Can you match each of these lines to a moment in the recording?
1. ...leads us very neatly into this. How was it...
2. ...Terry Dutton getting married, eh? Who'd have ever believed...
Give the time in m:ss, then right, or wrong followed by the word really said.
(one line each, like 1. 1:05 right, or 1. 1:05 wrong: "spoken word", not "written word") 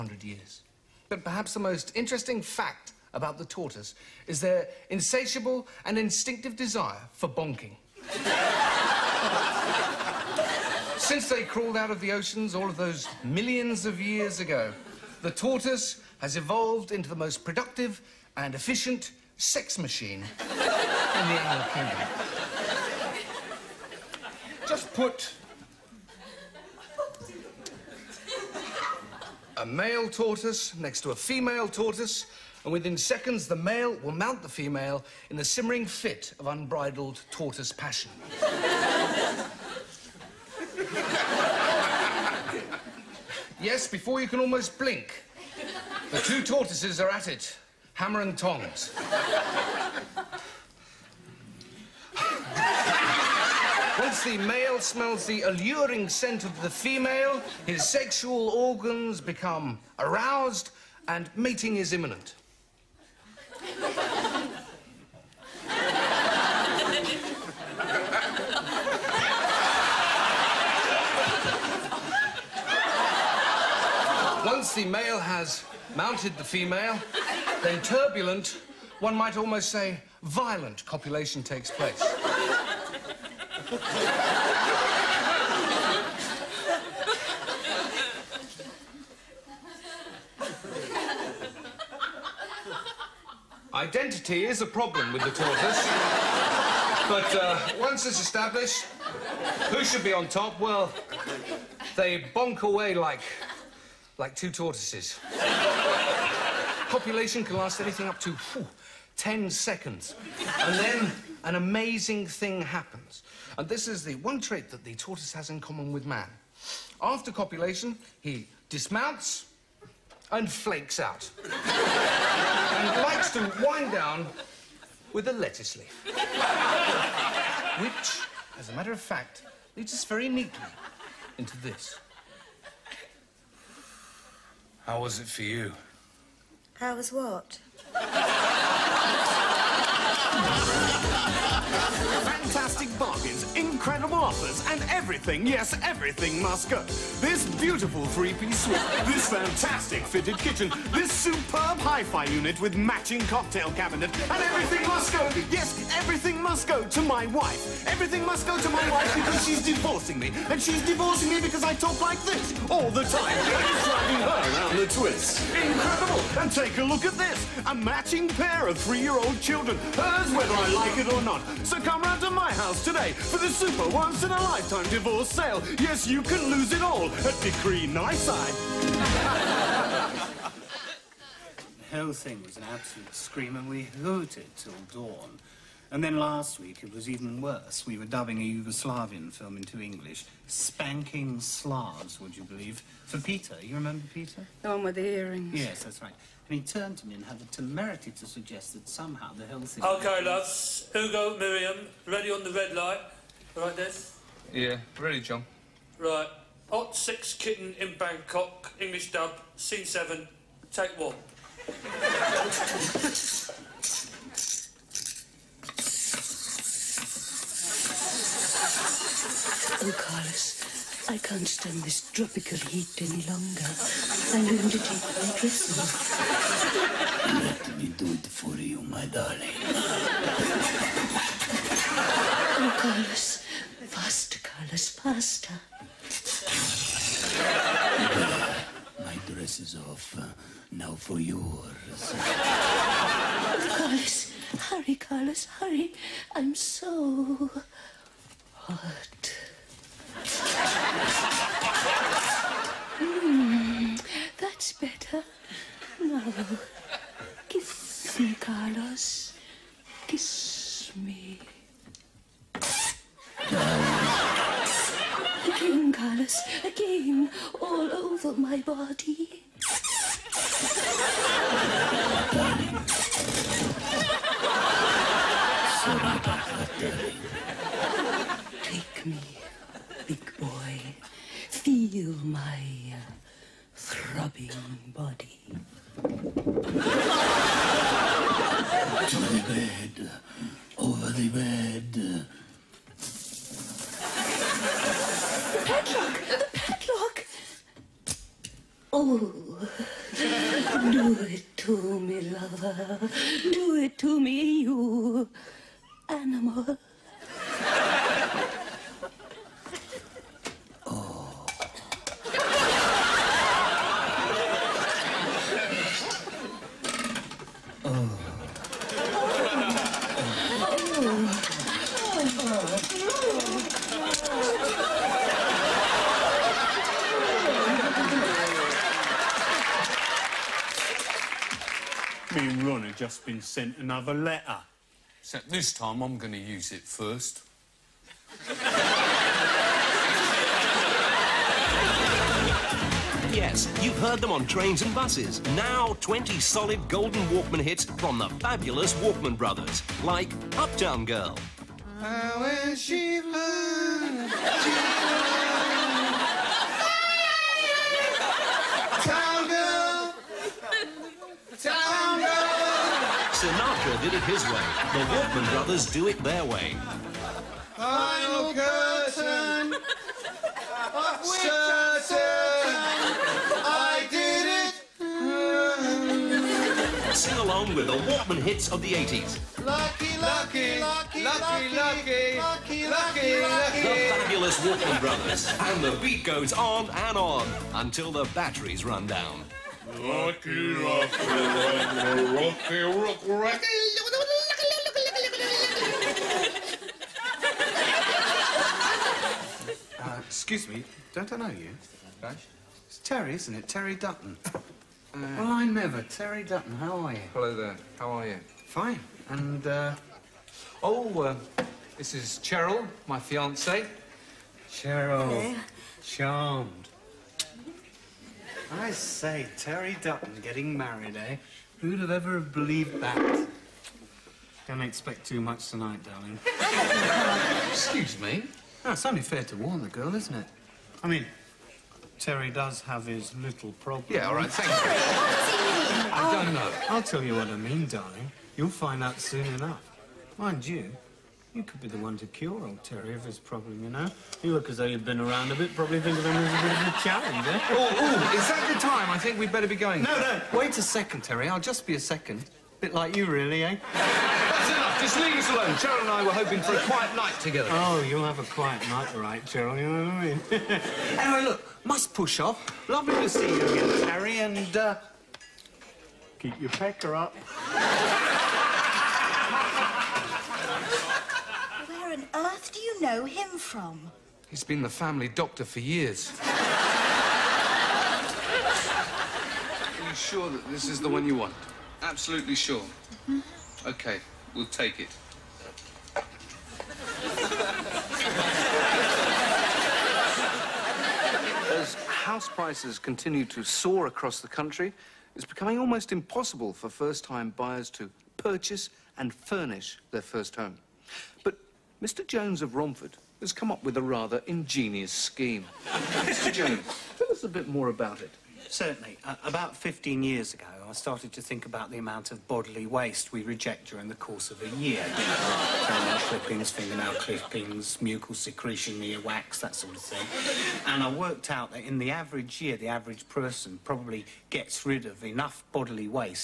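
1. 2:09 right
2. 6:59 right.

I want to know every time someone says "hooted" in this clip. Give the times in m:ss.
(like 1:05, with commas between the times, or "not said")
3:03.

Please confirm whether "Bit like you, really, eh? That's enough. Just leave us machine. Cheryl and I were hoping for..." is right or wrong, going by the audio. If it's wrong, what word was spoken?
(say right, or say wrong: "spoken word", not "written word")
wrong: "alone", not "machine".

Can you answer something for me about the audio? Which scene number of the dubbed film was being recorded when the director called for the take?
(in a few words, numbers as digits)
7.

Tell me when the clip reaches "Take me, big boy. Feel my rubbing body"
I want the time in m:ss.
4:38.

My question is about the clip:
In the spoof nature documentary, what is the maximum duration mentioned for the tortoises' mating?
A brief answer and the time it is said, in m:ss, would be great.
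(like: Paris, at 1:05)
10 seconds, at 1:49.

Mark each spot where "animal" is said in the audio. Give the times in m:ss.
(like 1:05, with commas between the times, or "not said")
0:21, 5:06.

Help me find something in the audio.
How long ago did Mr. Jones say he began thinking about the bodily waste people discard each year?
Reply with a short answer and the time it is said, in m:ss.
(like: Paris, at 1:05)
15 years, at 8:29.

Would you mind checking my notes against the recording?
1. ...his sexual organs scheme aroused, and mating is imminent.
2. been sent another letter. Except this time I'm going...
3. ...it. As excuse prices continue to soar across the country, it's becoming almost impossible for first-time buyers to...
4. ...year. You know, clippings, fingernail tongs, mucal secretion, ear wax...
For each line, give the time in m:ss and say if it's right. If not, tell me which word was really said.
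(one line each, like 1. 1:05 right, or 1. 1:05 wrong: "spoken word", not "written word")
1. 0:57 wrong: "become", not "scheme"
2. 5:33 right
3. 8:05 wrong: "house", not "excuse"
4. 8:34 wrong: "clippings", not "tongs".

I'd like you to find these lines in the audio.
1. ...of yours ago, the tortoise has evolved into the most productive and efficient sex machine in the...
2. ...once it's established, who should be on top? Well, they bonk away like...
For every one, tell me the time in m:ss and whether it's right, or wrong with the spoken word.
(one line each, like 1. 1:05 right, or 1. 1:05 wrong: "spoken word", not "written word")
1. 0:13 wrong: "years", not "yours"
2. 1:37 right.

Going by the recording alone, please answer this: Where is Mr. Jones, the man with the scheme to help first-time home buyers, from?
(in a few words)
Romford.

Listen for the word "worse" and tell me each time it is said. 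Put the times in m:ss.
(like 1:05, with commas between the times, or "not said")
3:07.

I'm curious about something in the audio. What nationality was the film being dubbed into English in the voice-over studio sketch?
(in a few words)
Yugoslavian.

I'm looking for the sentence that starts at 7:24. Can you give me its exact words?
You look as though you've been around a bit.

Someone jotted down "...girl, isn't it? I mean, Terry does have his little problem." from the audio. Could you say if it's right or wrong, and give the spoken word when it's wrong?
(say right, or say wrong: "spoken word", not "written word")
right.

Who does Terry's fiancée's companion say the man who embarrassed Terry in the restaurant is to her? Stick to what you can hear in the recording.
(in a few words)
family doctor.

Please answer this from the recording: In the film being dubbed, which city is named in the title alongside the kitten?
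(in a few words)
Bangkok.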